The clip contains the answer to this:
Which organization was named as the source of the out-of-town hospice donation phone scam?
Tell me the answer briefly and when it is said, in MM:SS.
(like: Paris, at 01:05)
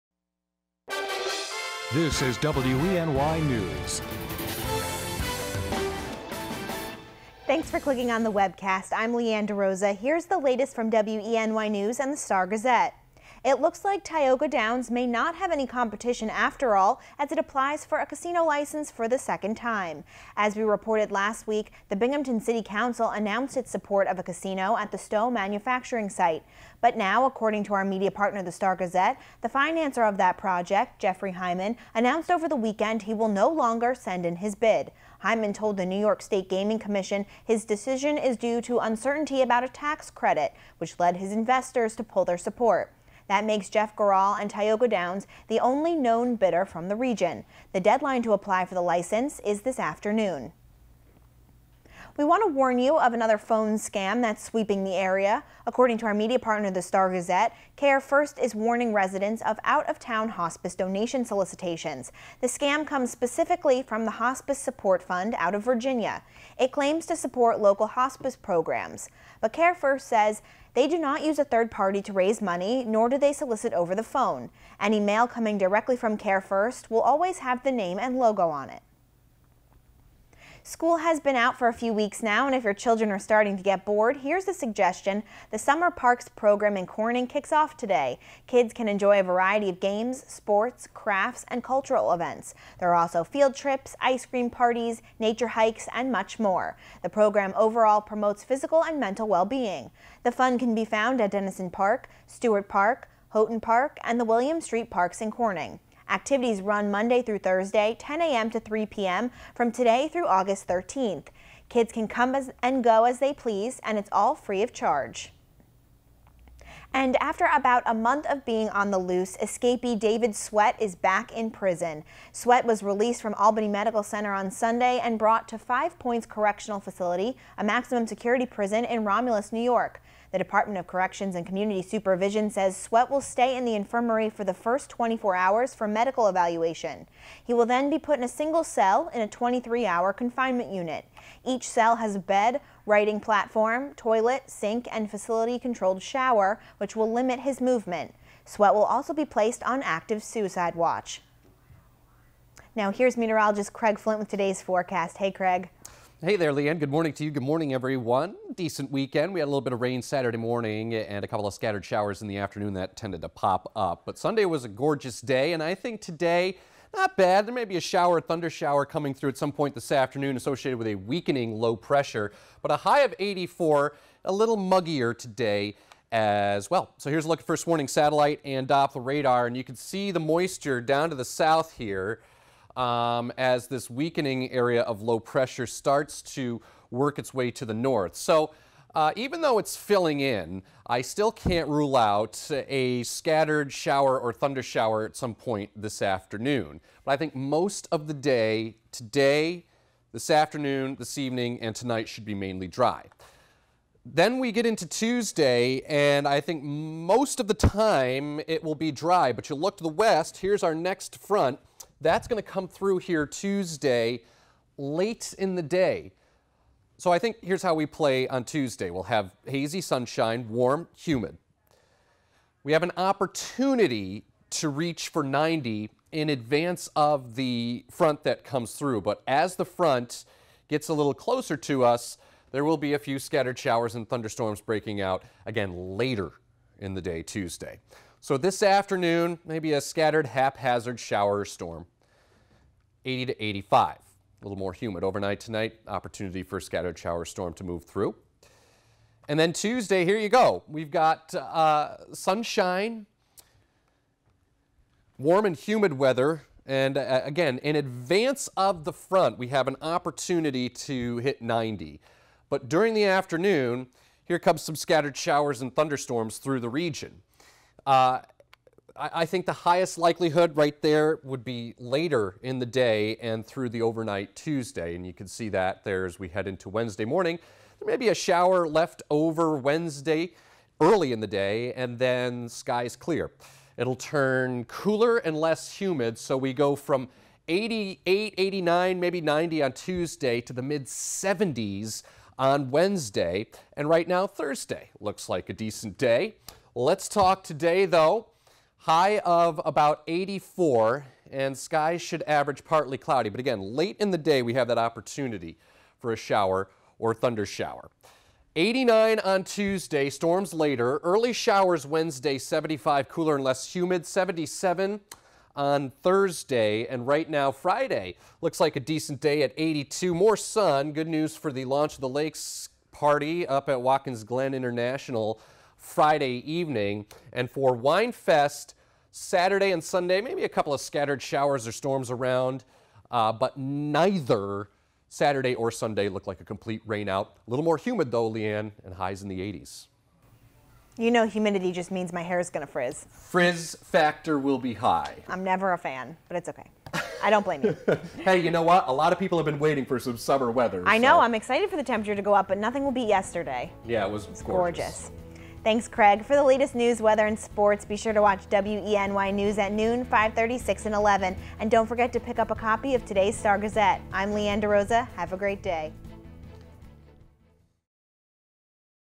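Hospice Support Fund, at 01:04.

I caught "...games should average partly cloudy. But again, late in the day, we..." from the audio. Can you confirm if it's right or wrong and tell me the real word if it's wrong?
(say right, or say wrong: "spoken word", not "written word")
wrong: "skies", not "games".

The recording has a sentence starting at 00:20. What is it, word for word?
As we reported last week, the Binghamton City Council announced its support of a casino at the Stow manufacturing site.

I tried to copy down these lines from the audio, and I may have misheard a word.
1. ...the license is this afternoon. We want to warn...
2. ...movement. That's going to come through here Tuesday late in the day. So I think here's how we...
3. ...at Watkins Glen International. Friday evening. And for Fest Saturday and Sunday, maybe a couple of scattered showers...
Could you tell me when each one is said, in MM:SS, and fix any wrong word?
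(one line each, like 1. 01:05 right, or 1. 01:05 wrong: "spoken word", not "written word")
1. 00:48 right
2. 03:31 wrong: "front", not "movement"
3. 05:23 right.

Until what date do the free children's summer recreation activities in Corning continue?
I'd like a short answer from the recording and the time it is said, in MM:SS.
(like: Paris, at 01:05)
August 13th, at 01:50.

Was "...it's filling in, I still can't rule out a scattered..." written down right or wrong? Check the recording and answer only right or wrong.
right.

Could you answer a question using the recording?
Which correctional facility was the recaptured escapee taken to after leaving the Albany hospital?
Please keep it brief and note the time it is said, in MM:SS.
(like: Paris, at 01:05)
Five Points Correctional Facility, at 02:05.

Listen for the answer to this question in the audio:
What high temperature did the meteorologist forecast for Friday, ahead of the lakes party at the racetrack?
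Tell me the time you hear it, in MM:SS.
05:19.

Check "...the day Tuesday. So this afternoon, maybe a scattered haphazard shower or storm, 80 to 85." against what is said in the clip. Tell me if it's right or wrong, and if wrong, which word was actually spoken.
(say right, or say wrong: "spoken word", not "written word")
right.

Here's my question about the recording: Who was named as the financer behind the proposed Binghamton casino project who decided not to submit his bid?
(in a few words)
Jeffrey Hyman.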